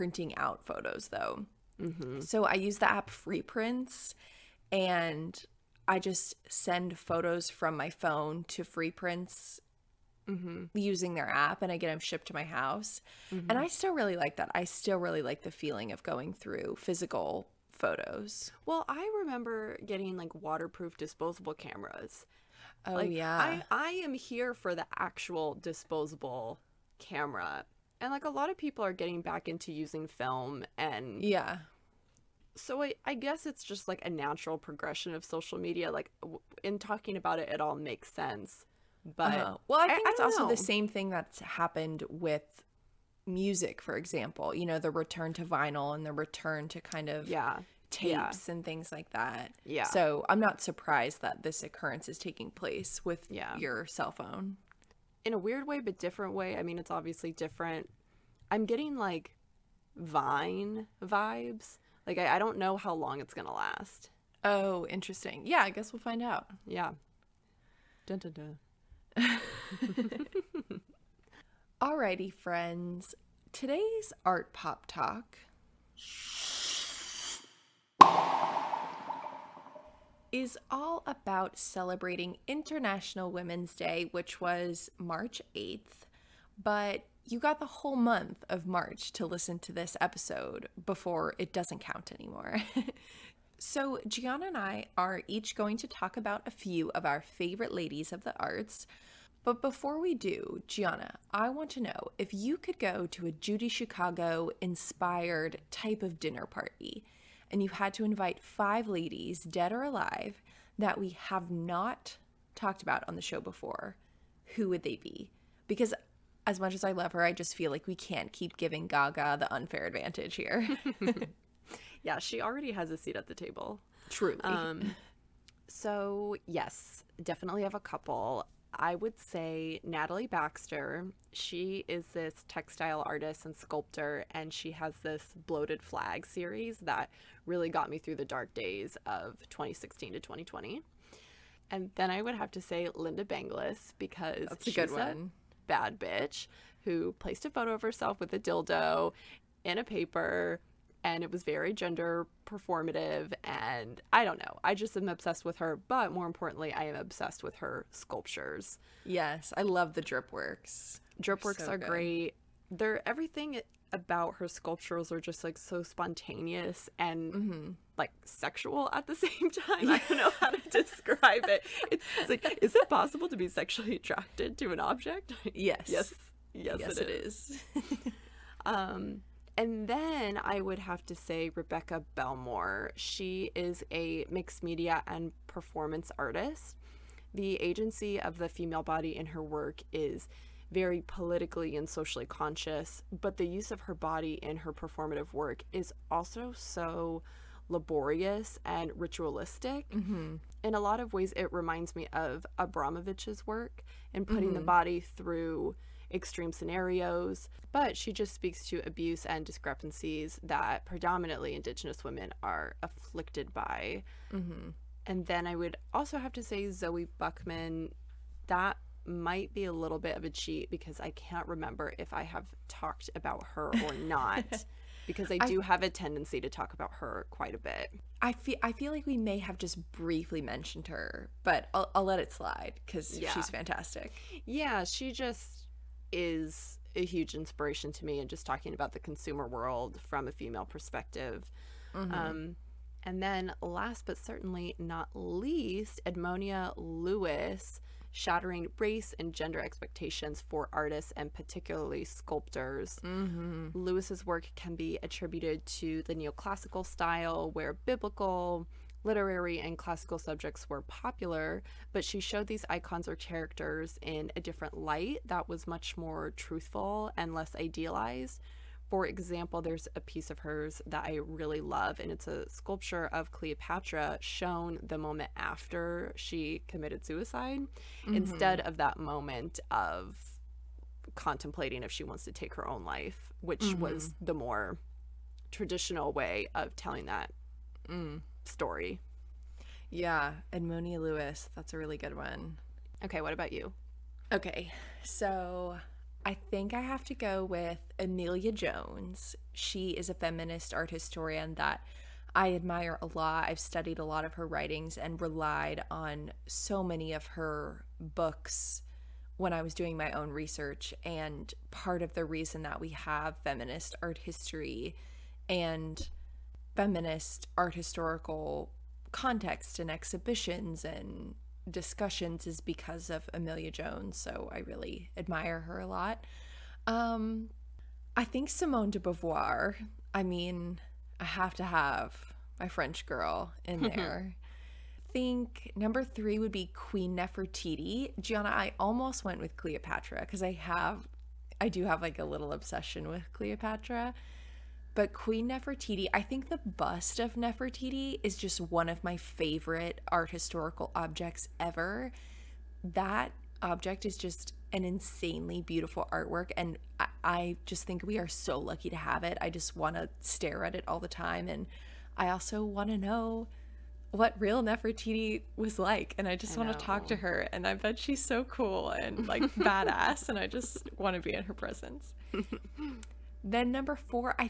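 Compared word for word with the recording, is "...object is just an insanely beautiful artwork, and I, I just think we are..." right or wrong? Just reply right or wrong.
right.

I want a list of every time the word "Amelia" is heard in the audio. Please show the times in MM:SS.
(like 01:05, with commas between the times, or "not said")
04:57, 05:23.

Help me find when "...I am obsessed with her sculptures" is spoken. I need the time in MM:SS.
02:36.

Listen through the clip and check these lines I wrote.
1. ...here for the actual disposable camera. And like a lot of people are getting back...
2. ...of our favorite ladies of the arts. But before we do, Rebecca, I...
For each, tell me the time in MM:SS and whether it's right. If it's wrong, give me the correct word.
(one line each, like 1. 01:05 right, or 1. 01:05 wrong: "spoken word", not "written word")
1. 00:24 right
2. 01:36 wrong: "Gianna", not "Rebecca".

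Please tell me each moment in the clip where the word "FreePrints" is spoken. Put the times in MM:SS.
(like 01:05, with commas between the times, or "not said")
00:03, 00:08.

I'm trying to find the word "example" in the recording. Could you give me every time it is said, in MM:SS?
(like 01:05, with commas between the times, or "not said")
00:43, 04:29.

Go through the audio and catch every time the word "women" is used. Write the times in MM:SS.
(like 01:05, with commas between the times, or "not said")
01:23, 03:32.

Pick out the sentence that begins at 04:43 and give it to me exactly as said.
was the more traditional way of telling that.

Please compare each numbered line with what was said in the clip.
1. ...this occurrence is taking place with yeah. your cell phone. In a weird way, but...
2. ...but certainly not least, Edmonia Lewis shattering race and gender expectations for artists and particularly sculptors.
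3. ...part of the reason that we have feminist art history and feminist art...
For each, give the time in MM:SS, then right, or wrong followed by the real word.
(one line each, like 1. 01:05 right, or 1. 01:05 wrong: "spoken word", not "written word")
1. 00:51 right
2. 04:04 right
3. 05:11 right.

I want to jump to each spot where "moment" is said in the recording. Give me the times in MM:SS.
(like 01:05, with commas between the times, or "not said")
04:34, 04:38.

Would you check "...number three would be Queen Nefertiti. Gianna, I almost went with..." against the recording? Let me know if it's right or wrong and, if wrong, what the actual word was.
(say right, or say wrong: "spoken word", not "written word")
right.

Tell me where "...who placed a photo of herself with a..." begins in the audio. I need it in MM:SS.
02:26.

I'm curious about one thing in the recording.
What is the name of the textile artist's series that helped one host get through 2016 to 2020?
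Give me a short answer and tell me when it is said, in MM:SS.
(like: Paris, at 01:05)
Bloated Flag, at 02:15.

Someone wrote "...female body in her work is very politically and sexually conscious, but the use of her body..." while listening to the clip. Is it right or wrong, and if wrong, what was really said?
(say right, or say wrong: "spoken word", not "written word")
wrong: "socially", not "sexually".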